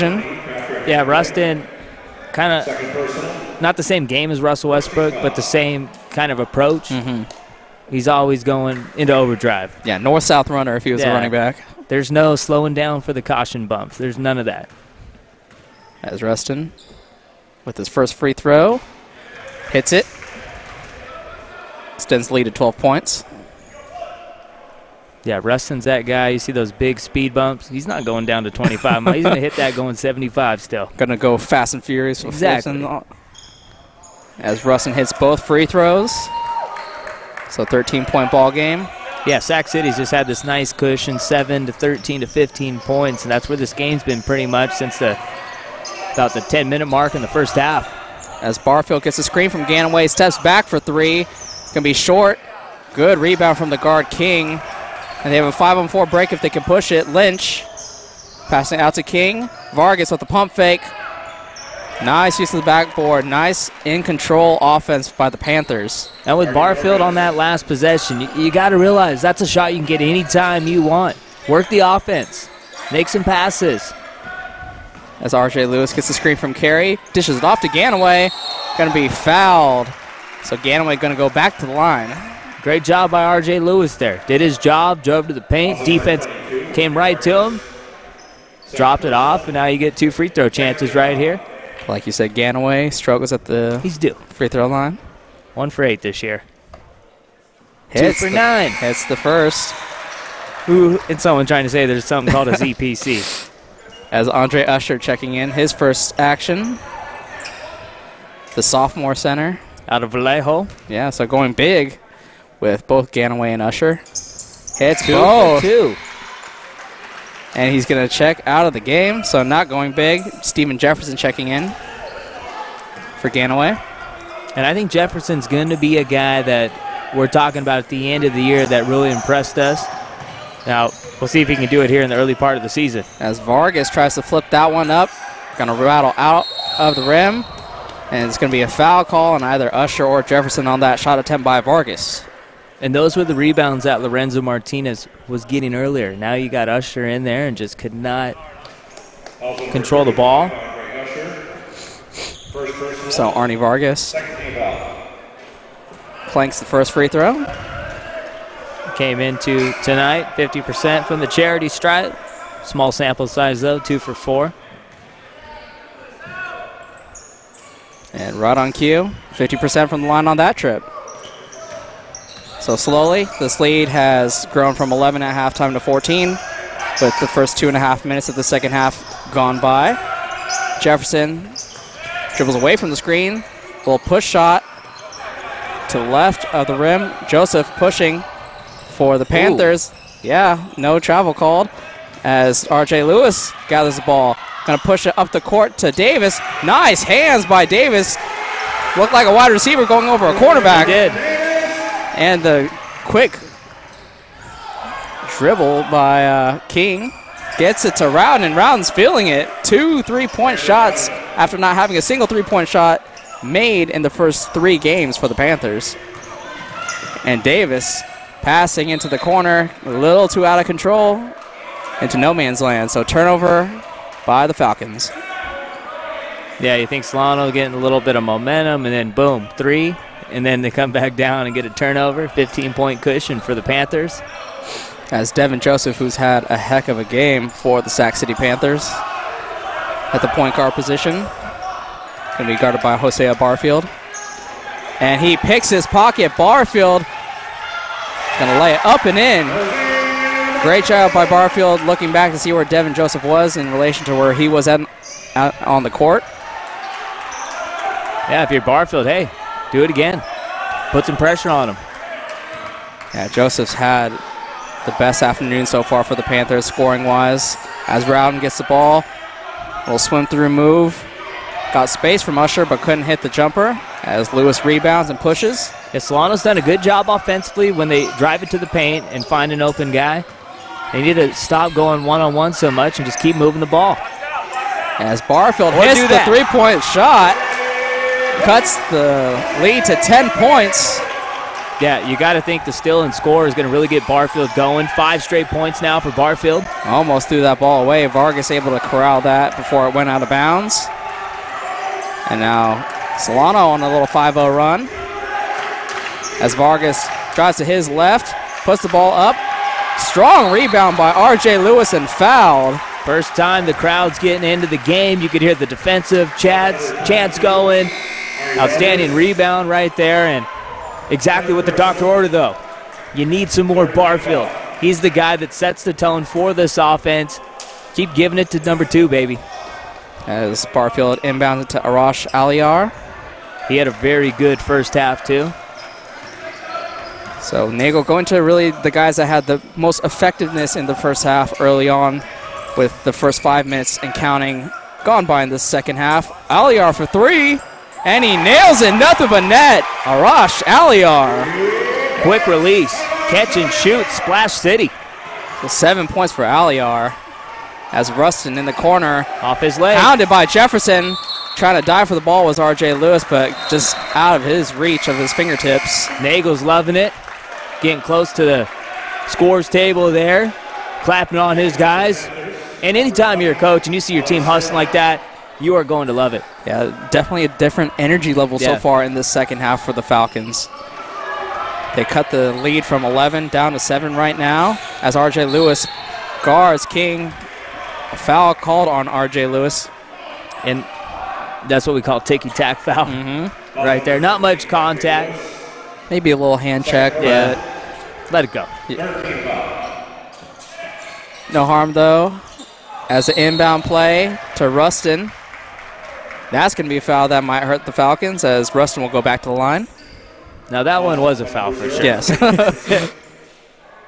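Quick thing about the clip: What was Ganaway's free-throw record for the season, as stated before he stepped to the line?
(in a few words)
1 for 8.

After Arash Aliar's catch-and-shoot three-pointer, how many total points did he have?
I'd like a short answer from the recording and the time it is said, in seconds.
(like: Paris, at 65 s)
7, at 355 s.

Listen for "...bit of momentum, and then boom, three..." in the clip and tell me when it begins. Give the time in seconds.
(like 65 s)
228 s.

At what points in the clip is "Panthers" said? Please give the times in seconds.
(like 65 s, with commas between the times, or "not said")
65 s, 189 s, 215 s, 233 s, 238 s, 266 s.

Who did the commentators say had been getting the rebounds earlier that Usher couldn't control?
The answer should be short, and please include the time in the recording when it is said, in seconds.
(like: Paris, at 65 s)
Lorenzo Martinez, at 144 s.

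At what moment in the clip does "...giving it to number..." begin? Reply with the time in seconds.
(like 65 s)
328 s.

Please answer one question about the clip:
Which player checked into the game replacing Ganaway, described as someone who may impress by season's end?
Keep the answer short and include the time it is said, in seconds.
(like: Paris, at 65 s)
Steven Jefferson, at 120 s.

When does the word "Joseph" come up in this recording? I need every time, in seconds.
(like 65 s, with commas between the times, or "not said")
187 s, 235 s, 252 s, 263 s.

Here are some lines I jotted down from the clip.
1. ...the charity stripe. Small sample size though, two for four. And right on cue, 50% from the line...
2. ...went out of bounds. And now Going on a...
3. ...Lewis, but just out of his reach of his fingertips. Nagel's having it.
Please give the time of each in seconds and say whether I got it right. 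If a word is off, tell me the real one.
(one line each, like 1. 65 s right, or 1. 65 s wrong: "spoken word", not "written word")
1. 161 s right
2. 299 s wrong: "Solano", not "Going"
3. 362 s wrong: "loving", not "having".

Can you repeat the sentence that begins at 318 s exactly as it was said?
Outstanding rebound right there, and exactly what the doctor ordered, though.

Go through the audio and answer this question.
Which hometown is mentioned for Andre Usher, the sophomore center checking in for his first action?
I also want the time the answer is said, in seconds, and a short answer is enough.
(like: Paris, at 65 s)
Vallejo, at 110 s.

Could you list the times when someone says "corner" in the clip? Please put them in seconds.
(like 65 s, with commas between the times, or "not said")
219 s, 358 s.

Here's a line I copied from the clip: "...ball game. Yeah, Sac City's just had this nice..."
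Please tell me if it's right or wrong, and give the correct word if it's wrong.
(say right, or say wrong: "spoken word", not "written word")
right.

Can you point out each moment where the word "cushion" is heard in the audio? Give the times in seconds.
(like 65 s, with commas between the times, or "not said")
40 s, 233 s.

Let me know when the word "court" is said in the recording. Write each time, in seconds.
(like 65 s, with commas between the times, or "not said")
195 s, 255 s.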